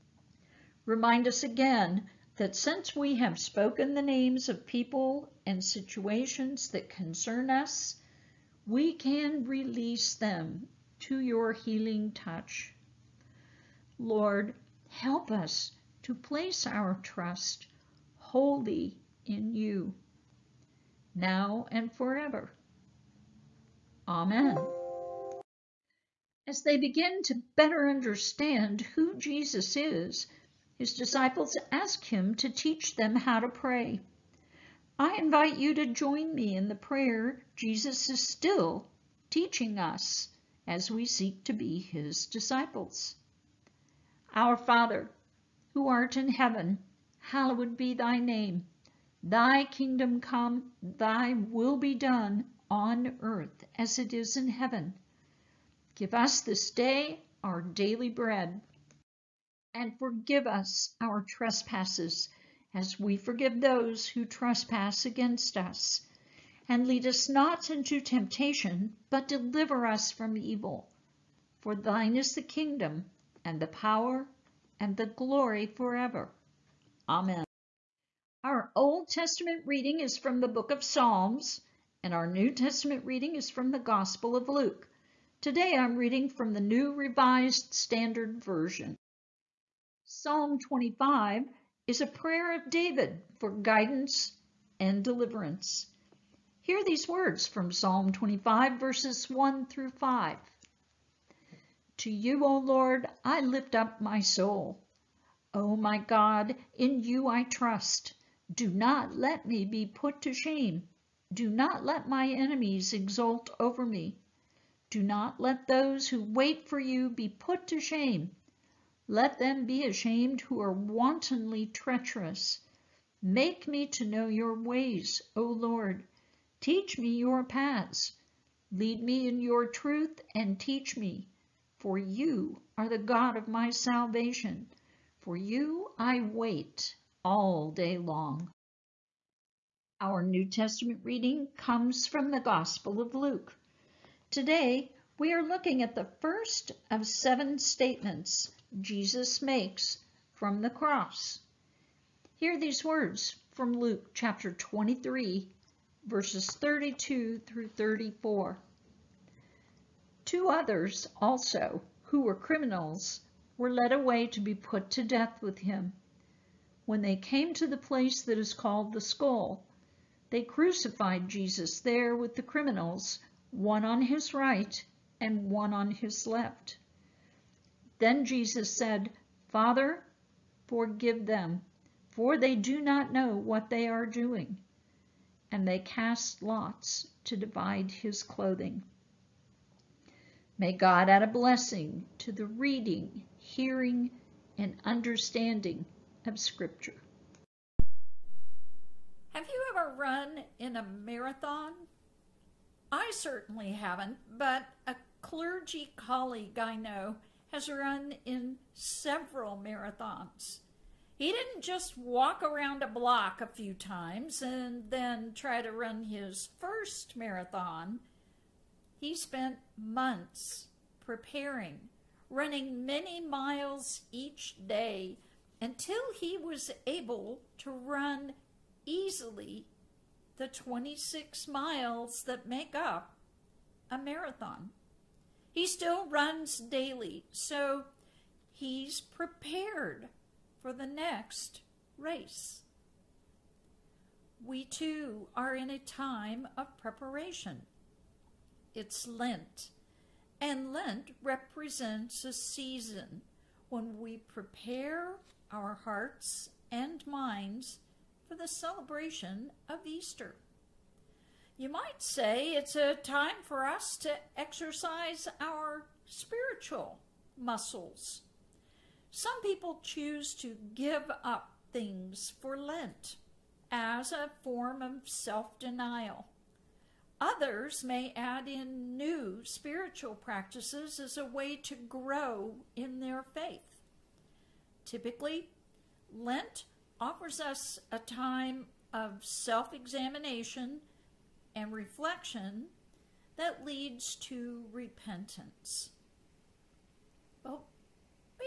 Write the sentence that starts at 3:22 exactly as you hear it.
I certainly haven't, but a clergy colleague I know has run in several marathons.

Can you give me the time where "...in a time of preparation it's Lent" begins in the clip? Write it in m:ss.
4:05.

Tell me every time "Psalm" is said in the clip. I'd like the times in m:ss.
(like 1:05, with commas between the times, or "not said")
1:20, 1:30, 1:37.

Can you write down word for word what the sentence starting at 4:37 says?
Others may add in new spiritual practices as a way to grow in their faith.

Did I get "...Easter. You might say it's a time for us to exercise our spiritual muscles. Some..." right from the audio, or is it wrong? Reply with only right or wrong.
right.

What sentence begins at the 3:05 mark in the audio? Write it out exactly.
And they cast lots to divide his clothing.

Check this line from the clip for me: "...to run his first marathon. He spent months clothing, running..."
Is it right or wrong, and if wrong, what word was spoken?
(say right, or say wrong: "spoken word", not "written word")
wrong: "preparing", not "clothing".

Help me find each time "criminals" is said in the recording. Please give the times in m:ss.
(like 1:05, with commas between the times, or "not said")
2:42, 2:52.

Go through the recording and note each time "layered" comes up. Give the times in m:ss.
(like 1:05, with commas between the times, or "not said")
not said.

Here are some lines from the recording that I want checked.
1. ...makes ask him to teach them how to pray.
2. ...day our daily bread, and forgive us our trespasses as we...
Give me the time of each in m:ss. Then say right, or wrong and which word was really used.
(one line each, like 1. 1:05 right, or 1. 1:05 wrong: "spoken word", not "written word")
1. 0:30 wrong: "disciples", not "makes"
2. 0:56 right.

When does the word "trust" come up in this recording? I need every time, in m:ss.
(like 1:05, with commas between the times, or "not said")
0:17, 1:47.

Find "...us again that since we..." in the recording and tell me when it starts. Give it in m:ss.
0:01.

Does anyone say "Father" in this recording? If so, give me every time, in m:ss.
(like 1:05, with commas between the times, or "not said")
0:44, 2:59.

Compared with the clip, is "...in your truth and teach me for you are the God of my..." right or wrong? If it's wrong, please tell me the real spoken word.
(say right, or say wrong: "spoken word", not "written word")
right.